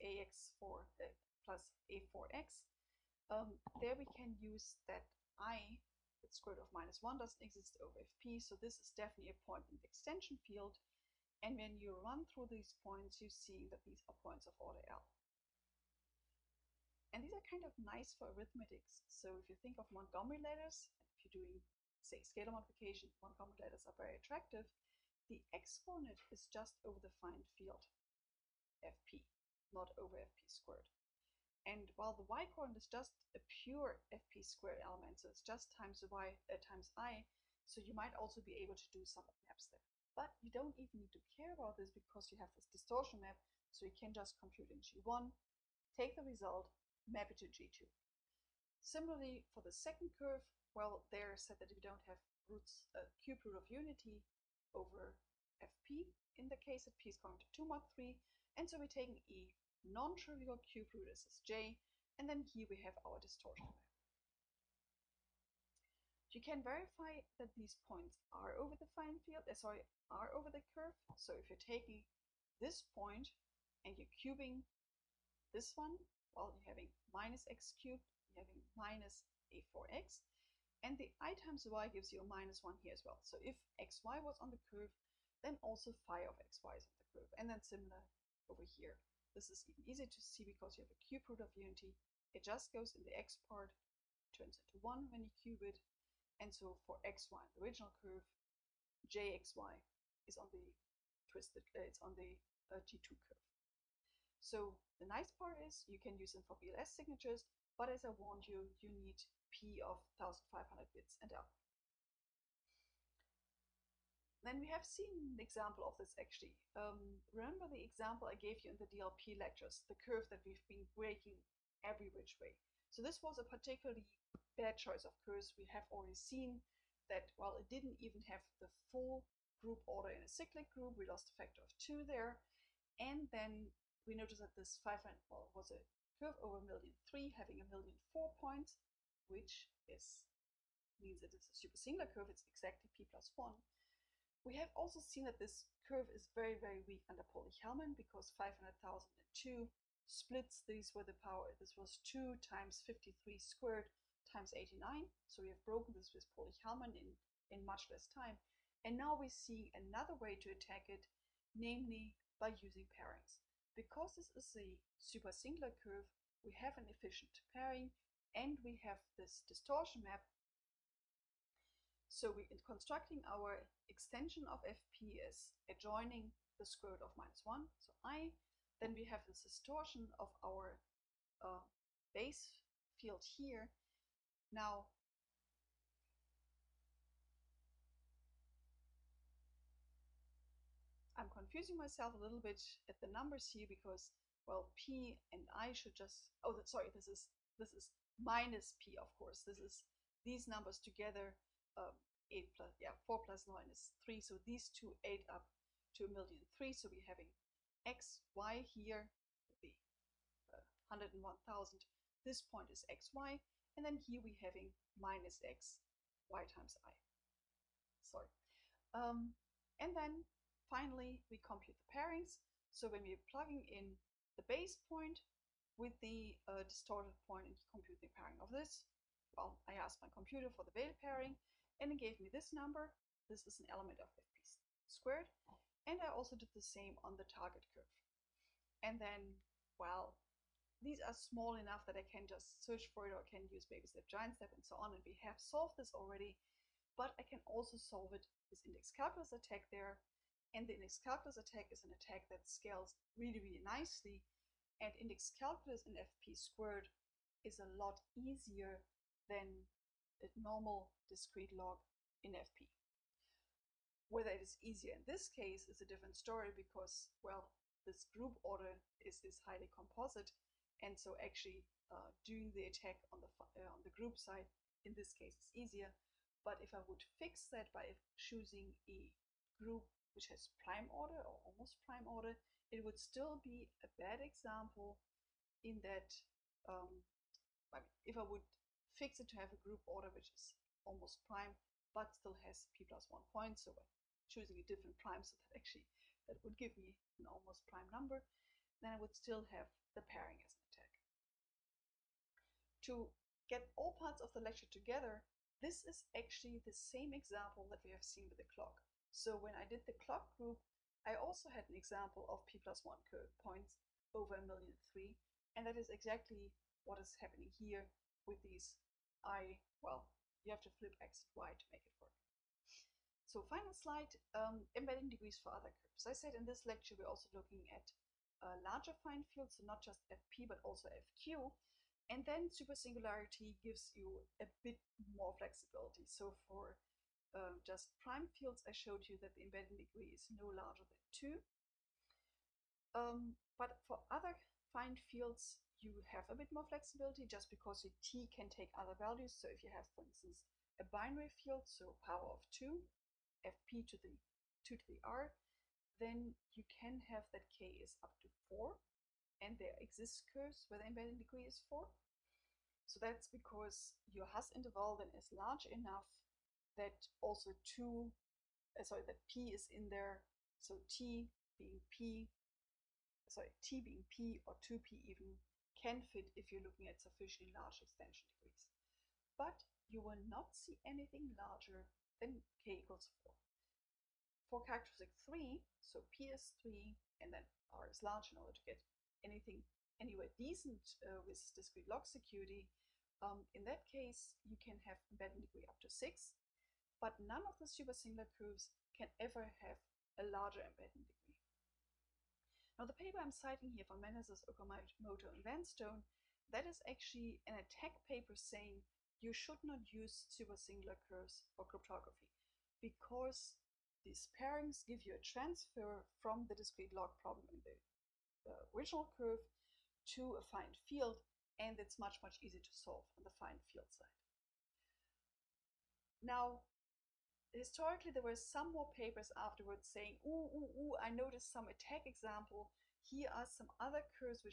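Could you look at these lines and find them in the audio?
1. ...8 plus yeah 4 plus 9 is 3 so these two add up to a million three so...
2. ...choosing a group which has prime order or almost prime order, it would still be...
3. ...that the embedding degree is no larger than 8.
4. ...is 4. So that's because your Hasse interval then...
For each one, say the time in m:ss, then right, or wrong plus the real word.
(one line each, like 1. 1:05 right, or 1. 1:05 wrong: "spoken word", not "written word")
1. 3:22 right
2. 4:38 right
3. 5:39 wrong: "2", not "8"
4. 6:01 right.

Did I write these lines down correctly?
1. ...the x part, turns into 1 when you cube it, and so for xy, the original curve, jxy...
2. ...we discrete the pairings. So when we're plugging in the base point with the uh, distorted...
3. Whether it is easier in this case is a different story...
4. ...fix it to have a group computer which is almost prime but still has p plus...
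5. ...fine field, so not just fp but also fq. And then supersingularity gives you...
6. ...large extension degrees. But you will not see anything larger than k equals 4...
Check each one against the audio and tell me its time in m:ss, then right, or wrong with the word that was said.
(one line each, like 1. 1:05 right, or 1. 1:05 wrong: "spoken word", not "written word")
1. 1:33 right
2. 3:41 wrong: "compute", not "discrete"
3. 4:24 right
4. 4:48 wrong: "order", not "computer"
5. 5:29 right
6. 6:17 right.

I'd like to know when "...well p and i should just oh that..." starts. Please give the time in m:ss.
3:14.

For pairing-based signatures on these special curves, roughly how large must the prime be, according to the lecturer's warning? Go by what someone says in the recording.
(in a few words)
1500 bits.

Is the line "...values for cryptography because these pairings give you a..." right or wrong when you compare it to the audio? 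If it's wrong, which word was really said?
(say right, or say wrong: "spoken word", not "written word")
wrong: "curves", not "values".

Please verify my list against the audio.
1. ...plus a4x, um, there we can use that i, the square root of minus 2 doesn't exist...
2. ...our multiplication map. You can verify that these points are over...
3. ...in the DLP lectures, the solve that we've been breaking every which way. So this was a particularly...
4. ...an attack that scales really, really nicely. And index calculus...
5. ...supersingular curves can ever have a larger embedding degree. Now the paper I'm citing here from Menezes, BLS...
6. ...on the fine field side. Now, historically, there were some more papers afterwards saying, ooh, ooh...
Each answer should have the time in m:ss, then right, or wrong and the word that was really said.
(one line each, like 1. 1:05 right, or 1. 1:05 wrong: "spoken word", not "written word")
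1. 0:01 wrong: "1", not "2"
2. 1:03 wrong: "distortion", not "multiplication"
3. 1:58 wrong: "curve", not "solve"
4. 4:11 right
5. 6:37 wrong: "Okamoto", not "BLS"
6. 7:03 right.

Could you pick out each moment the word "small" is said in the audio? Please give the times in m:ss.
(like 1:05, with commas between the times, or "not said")
4:01.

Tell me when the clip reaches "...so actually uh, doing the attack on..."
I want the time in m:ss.
4:30.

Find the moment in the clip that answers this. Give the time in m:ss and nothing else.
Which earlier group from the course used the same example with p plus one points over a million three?
5:09.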